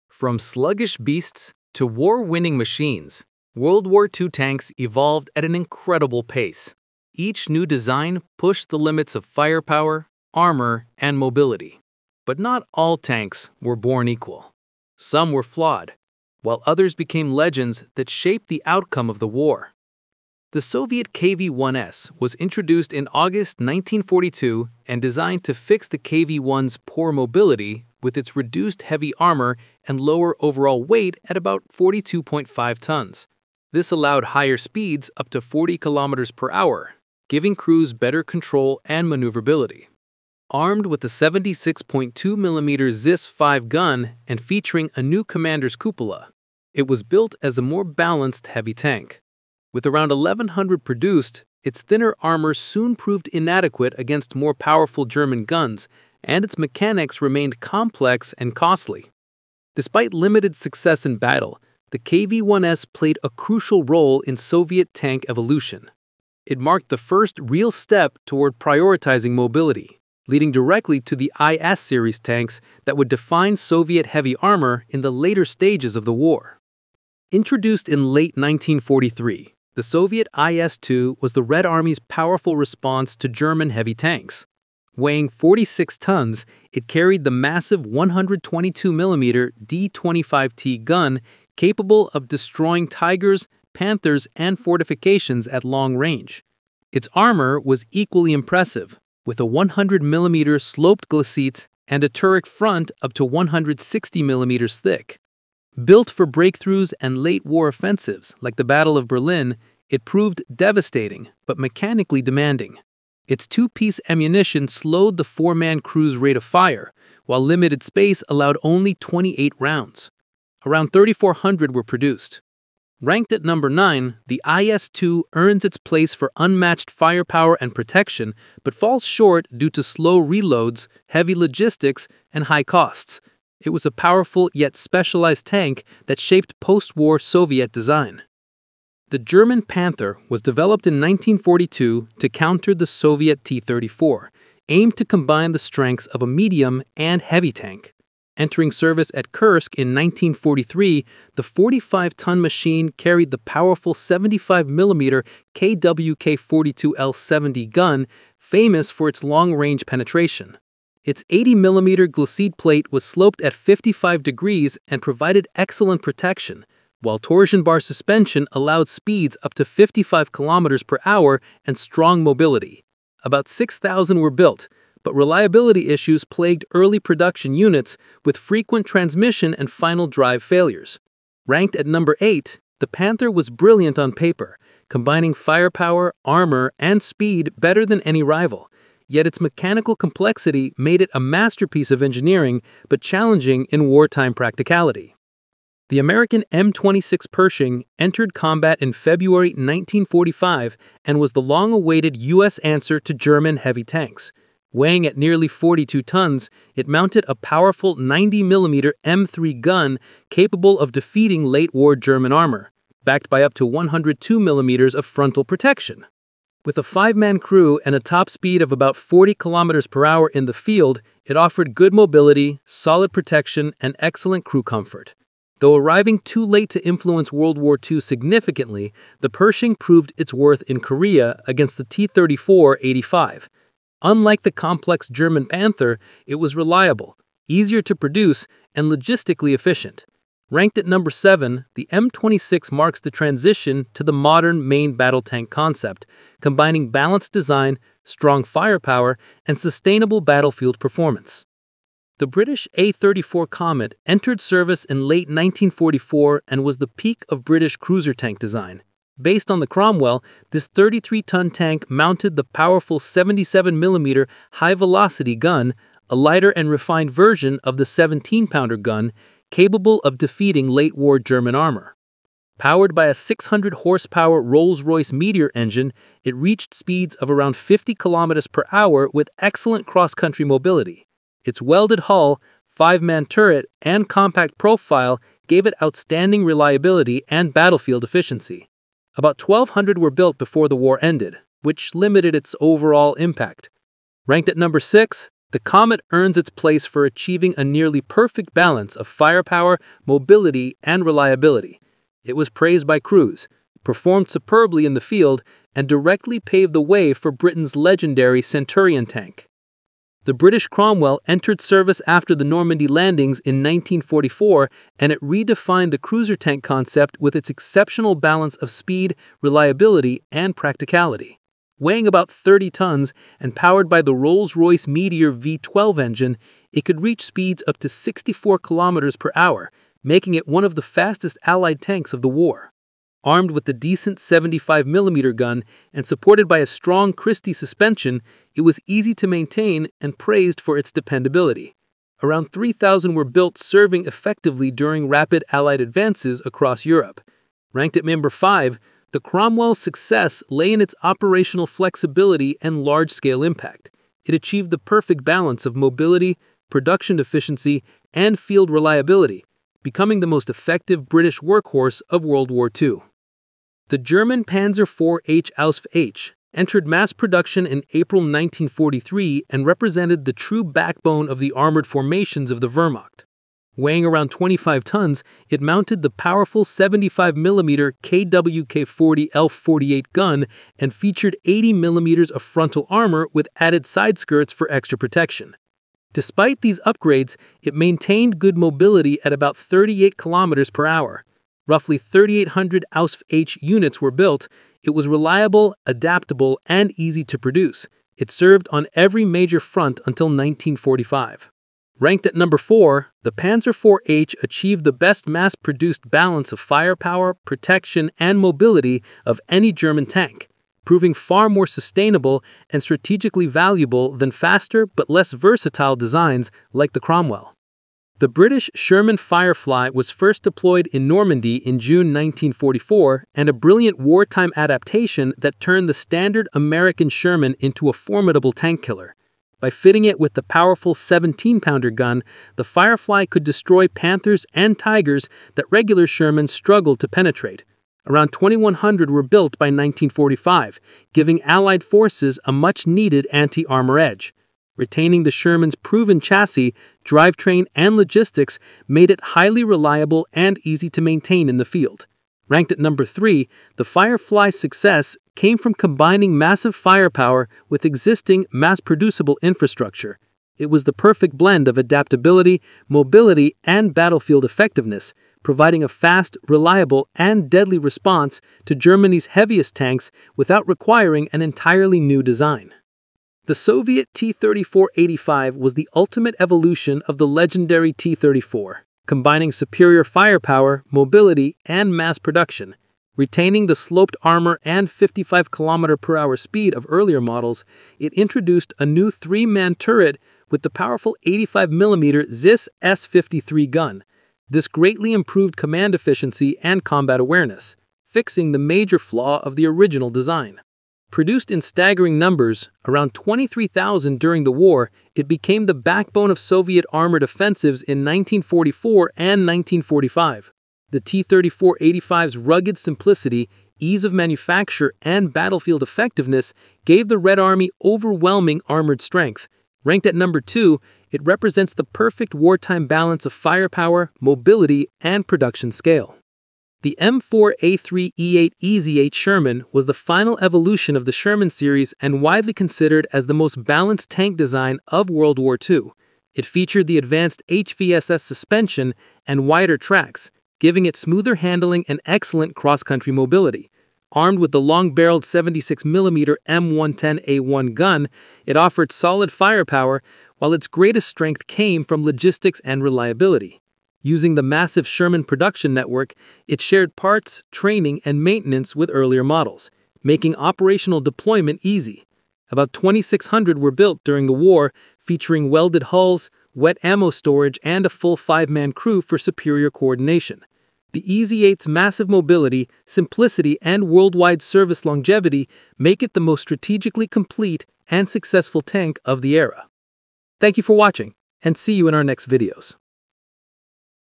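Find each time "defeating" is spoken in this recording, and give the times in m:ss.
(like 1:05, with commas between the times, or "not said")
3:30, 4:30.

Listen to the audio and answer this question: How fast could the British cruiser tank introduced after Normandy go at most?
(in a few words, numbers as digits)
64 km/h.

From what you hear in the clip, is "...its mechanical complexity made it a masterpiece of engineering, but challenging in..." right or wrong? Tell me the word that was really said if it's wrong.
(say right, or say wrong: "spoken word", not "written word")
right.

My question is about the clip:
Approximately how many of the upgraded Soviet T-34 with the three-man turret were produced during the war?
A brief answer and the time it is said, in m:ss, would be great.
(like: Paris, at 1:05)
23,000, at 8:23.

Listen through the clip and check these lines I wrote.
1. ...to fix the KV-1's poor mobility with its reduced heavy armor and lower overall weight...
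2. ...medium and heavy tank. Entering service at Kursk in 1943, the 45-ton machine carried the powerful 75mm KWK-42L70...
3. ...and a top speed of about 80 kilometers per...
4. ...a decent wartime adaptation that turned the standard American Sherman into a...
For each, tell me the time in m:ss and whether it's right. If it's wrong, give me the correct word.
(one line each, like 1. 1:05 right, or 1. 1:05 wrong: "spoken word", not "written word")
1. 0:25 right
2. 2:26 right
3. 3:37 wrong: "40", not "80"
4. 7:03 wrong: "brilliant", not "decent".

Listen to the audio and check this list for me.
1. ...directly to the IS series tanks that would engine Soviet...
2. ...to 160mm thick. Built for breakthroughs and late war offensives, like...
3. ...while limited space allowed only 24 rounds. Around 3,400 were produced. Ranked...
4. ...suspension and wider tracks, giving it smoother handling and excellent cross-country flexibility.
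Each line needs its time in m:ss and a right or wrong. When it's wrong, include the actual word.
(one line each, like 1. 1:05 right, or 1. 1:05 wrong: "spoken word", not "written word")
1. 1:10 wrong: "define", not "engine"
2. 1:43 right
3. 1:57 wrong: "28", not "24"
4. 8:58 wrong: "mobility", not "flexibility".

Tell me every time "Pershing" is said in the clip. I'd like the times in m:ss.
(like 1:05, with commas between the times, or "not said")
3:17, 3:49.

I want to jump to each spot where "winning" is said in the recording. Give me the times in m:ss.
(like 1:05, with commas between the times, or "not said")
0:01.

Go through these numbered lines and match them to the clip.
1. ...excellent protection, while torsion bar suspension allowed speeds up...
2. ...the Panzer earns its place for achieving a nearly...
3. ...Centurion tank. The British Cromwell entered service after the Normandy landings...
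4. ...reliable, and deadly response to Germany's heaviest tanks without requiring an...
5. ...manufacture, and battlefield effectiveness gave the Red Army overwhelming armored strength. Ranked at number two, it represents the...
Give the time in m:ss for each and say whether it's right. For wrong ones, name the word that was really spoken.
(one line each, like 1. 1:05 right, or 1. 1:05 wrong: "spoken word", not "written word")
1. 2:45 right
2. 4:55 wrong: "Comet", not "Panzer"
3. 5:08 right
4. 7:46 right
5. 8:34 right.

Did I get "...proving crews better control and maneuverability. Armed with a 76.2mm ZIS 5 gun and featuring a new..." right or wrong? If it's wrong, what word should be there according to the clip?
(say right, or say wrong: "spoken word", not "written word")
wrong: "giving", not "proving".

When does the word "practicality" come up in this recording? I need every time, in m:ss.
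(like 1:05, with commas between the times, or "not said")
3:14, 5:20.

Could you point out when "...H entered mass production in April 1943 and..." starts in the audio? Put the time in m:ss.
6:05.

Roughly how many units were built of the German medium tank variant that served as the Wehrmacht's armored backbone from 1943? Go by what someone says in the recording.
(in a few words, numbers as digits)
3,800.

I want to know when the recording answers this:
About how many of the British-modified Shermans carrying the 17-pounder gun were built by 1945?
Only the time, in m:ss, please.
7:18.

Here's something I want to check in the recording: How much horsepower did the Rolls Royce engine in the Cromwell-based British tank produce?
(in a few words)
600 horsepower.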